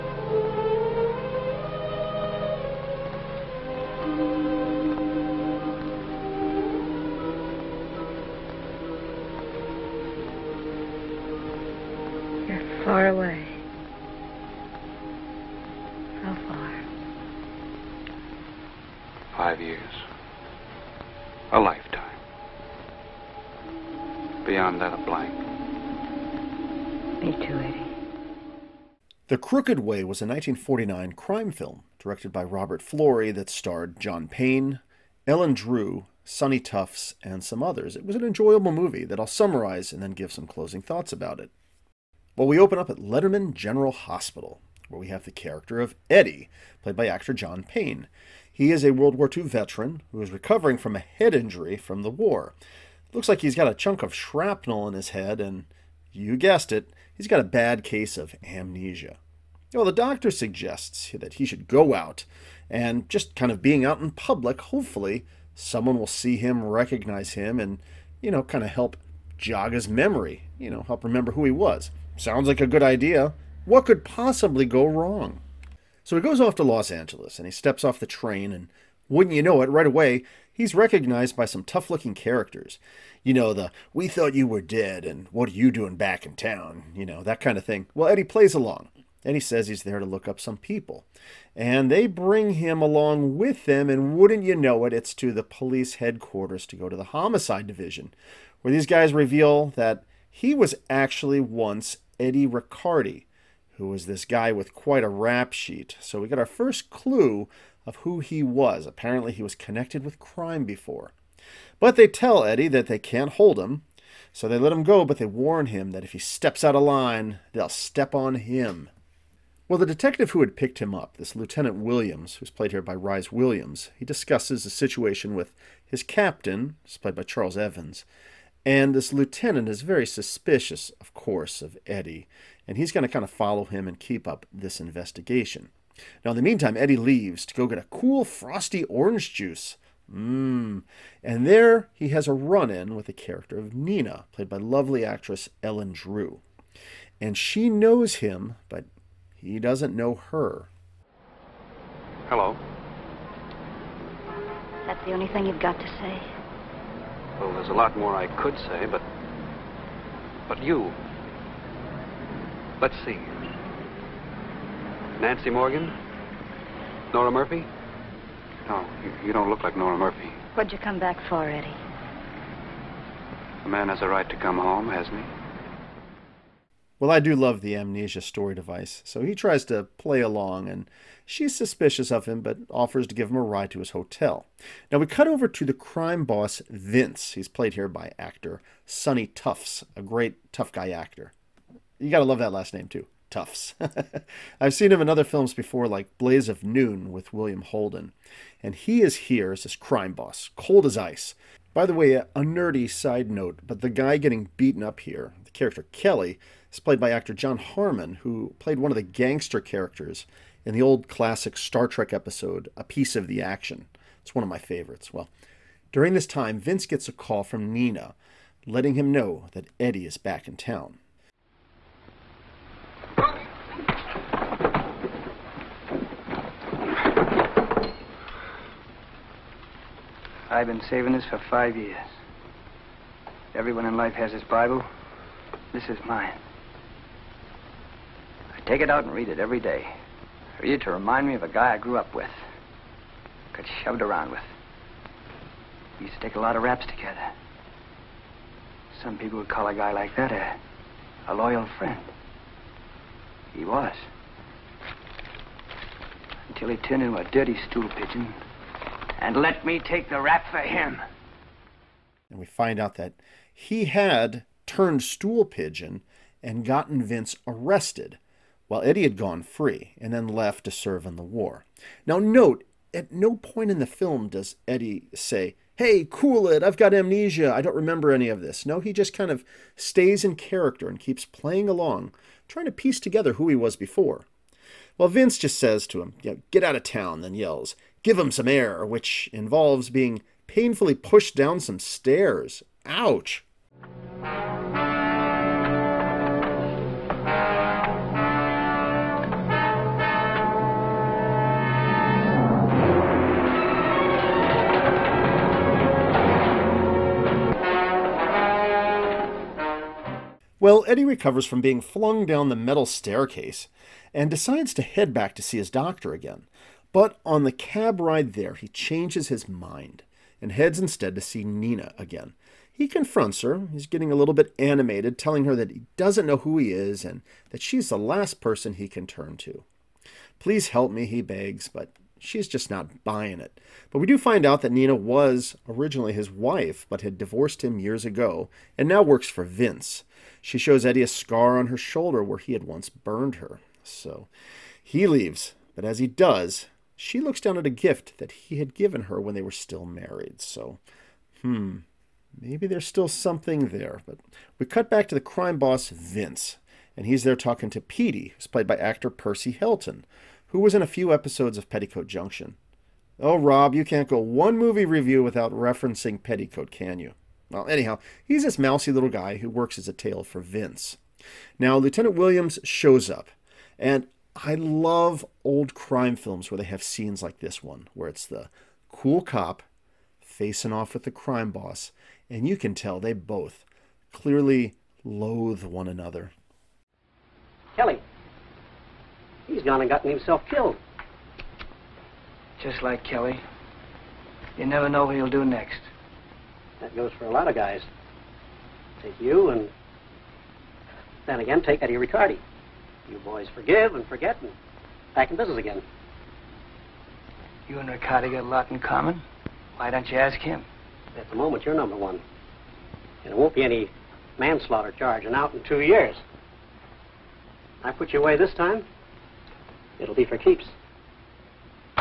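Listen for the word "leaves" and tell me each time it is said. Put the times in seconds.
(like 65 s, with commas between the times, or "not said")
136 s, 345 s.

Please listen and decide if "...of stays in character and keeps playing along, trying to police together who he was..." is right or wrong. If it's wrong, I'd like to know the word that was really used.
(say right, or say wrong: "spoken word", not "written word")
wrong: "piece", not "police".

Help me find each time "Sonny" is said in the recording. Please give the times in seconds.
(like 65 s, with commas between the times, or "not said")
36 s, 188 s.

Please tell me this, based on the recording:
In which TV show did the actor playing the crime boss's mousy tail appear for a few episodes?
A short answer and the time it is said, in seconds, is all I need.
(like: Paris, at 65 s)
Petticoat Junction, at 361 s.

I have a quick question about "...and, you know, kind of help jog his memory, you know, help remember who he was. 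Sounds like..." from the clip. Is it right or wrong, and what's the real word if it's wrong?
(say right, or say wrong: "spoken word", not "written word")
right.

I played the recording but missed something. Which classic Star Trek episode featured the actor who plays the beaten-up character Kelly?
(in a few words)
A Piece of the Action.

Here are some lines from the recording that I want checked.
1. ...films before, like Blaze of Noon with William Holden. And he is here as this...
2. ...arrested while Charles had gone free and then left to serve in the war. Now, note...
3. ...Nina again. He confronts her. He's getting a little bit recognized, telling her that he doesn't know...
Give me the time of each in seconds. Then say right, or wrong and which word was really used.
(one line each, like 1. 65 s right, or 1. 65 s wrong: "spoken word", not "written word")
1. 195 s right
2. 267 s wrong: "Eddie", not "Charles"
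3. 321 s wrong: "animated", not "recognized".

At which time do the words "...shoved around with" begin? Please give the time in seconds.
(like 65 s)
243 s.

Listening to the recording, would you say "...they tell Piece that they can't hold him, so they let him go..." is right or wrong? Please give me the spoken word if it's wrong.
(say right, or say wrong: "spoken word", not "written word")
wrong: "Eddie", not "Piece".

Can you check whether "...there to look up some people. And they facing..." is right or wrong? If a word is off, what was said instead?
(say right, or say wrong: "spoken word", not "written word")
wrong: "bring", not "facing".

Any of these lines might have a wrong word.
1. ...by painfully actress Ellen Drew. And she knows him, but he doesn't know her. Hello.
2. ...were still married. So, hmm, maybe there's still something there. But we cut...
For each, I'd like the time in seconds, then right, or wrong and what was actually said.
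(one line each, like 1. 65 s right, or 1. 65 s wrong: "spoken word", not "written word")
1. 144 s wrong: "lovely", not "painfully"
2. 349 s right.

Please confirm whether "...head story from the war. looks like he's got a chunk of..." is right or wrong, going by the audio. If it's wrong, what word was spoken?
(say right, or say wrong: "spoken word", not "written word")
wrong: "injury", not "story".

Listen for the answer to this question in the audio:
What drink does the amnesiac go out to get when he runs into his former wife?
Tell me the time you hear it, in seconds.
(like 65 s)
138 s.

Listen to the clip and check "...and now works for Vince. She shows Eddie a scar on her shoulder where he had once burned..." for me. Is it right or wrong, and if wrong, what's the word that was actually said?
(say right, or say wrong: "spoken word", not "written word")
right.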